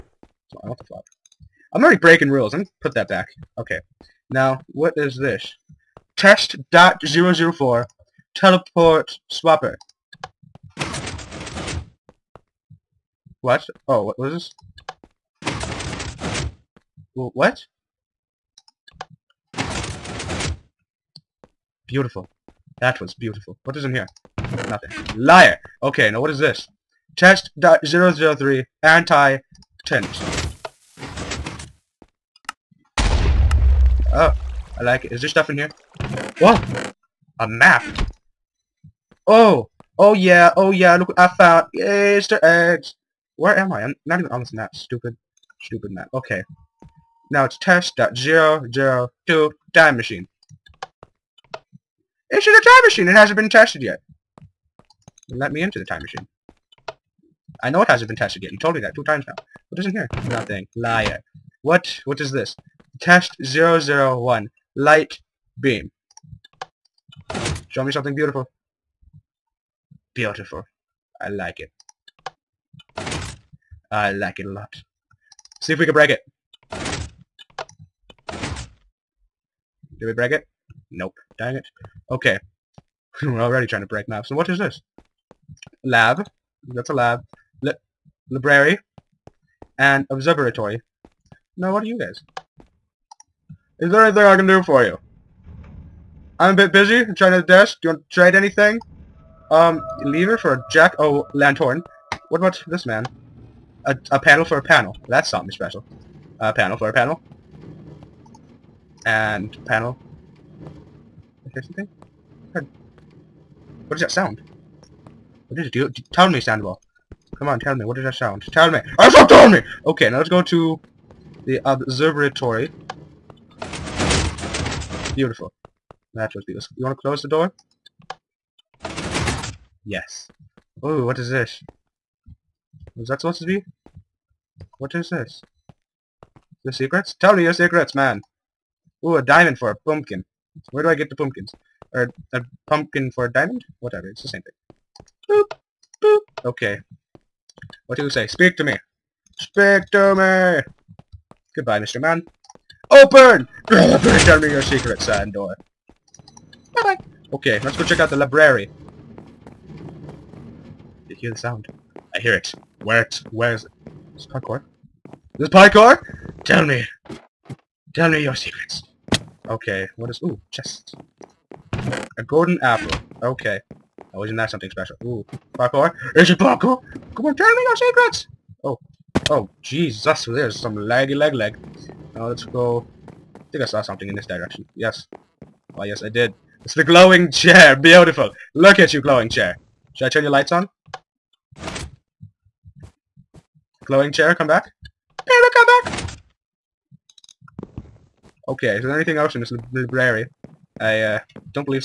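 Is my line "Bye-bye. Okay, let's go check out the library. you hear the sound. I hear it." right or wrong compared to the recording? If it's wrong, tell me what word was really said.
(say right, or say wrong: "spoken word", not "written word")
right.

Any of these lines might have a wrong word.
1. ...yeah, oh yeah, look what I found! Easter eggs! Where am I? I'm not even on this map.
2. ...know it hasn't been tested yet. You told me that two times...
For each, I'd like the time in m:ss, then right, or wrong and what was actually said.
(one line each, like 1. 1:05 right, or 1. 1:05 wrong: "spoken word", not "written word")
1. 0:40 right
2. 0:57 right.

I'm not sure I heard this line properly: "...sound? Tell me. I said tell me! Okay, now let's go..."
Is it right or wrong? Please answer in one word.
right.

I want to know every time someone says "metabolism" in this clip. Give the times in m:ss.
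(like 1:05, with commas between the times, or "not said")
not said.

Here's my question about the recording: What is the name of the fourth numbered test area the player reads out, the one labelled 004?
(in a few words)
Teleport swapper.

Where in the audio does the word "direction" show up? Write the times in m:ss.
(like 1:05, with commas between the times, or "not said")
3:04.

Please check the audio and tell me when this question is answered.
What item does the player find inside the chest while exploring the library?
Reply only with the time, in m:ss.
2:52.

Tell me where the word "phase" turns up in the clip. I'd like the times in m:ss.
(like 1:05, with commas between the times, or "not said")
not said.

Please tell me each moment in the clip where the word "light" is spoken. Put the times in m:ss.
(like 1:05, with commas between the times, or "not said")
1:04, 3:10.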